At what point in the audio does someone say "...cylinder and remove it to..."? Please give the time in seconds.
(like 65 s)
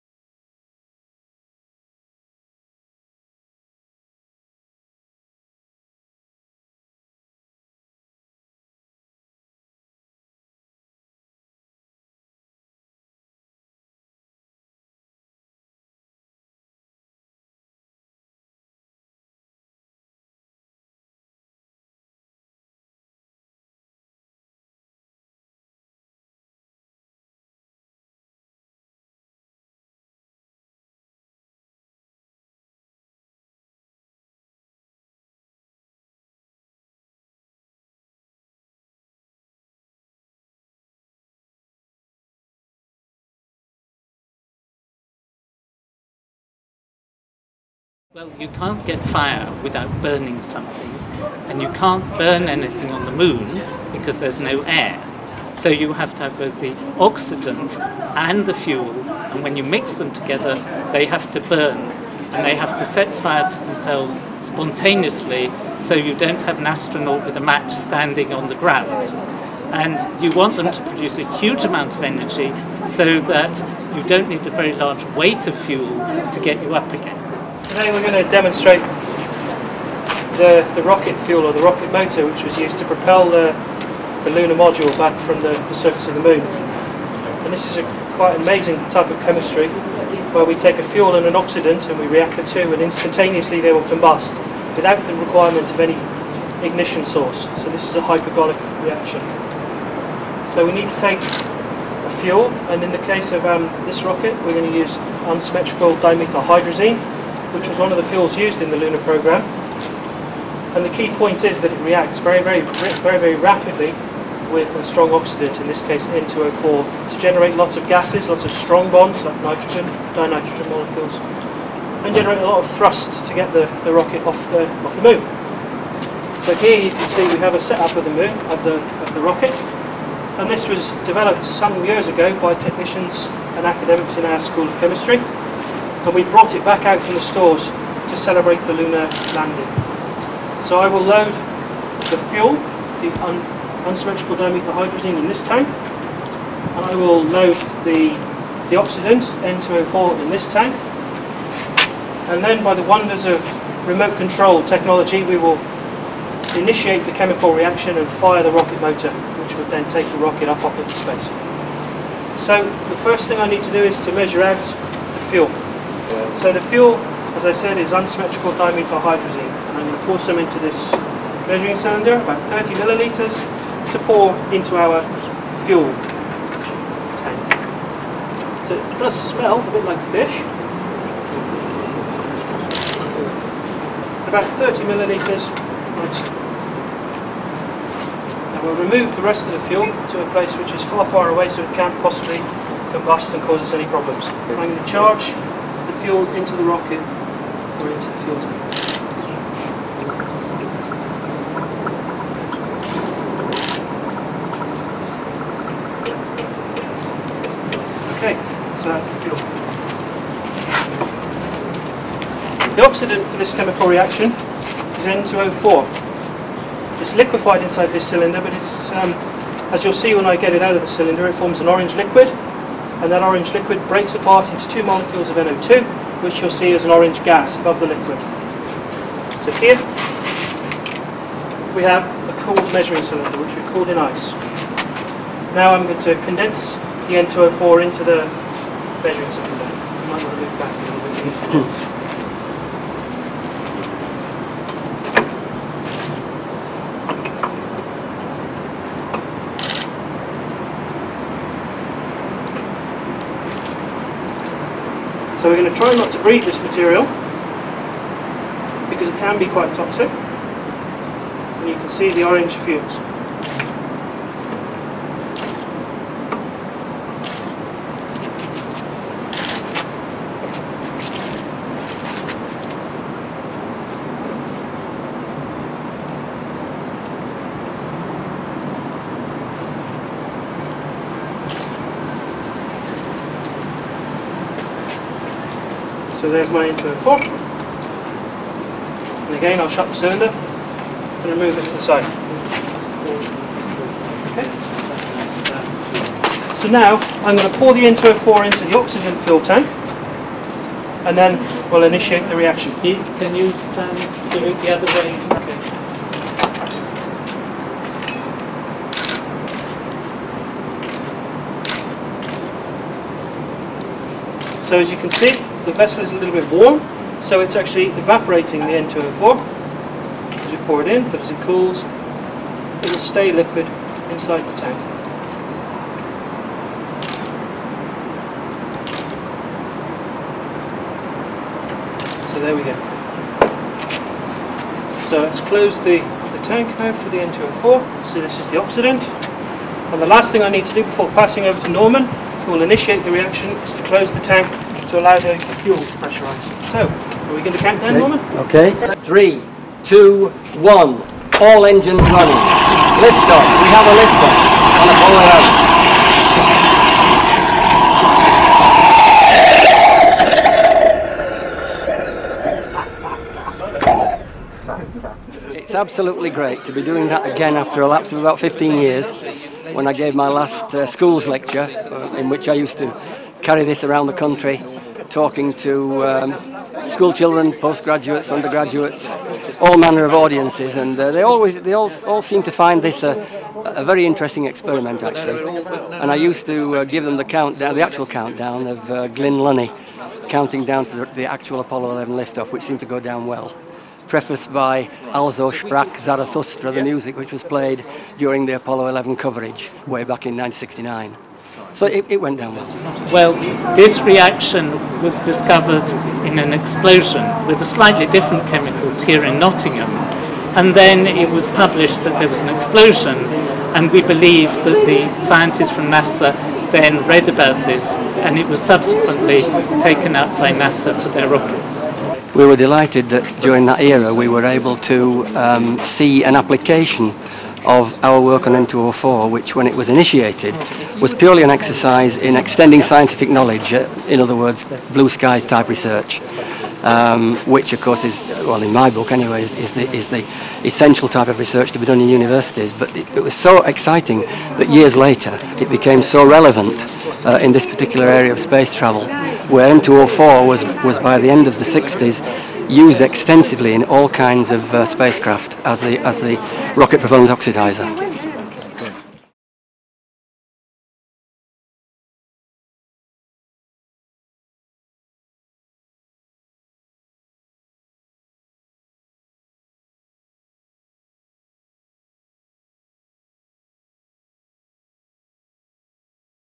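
289 s.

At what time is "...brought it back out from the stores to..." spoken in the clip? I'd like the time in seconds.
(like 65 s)
136 s.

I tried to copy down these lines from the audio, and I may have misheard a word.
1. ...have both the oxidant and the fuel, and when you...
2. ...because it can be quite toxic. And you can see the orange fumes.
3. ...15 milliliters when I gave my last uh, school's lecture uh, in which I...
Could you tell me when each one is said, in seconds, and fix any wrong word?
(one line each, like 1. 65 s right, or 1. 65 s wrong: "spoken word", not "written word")
1. 56 s right
2. 258 s right
3. 368 s wrong: "years", not "milliliters".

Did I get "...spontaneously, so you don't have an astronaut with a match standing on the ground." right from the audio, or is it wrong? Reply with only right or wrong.
right.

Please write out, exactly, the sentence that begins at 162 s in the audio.
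So the first thing I need to do is to measure out the fuel.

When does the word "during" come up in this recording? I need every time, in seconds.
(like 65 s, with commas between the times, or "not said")
398 s, 423 s.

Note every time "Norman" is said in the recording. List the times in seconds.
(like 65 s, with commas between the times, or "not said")
341 s, 347 s.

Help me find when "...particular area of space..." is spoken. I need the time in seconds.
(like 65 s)
447 s.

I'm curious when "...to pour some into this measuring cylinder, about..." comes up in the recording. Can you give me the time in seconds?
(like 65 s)
169 s.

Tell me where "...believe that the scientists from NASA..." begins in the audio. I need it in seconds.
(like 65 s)
414 s.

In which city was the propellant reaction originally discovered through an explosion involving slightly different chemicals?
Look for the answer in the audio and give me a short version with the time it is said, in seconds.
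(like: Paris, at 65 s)
Nottingham, at 409 s.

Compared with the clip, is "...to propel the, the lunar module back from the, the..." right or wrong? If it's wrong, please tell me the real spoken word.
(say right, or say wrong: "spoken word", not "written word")
right.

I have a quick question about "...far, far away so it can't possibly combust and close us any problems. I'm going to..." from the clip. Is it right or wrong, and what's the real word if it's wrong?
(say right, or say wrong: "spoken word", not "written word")
wrong: "cause", not "close".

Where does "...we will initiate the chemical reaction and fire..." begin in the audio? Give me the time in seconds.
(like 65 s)
155 s.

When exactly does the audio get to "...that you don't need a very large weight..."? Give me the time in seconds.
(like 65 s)
73 s.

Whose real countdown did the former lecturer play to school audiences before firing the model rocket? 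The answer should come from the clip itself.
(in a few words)
Glynn Lunney.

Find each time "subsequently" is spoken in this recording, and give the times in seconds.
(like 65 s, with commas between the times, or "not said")
418 s.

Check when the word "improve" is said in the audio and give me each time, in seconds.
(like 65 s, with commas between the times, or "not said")
not said.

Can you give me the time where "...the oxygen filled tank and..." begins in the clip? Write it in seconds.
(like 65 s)
298 s.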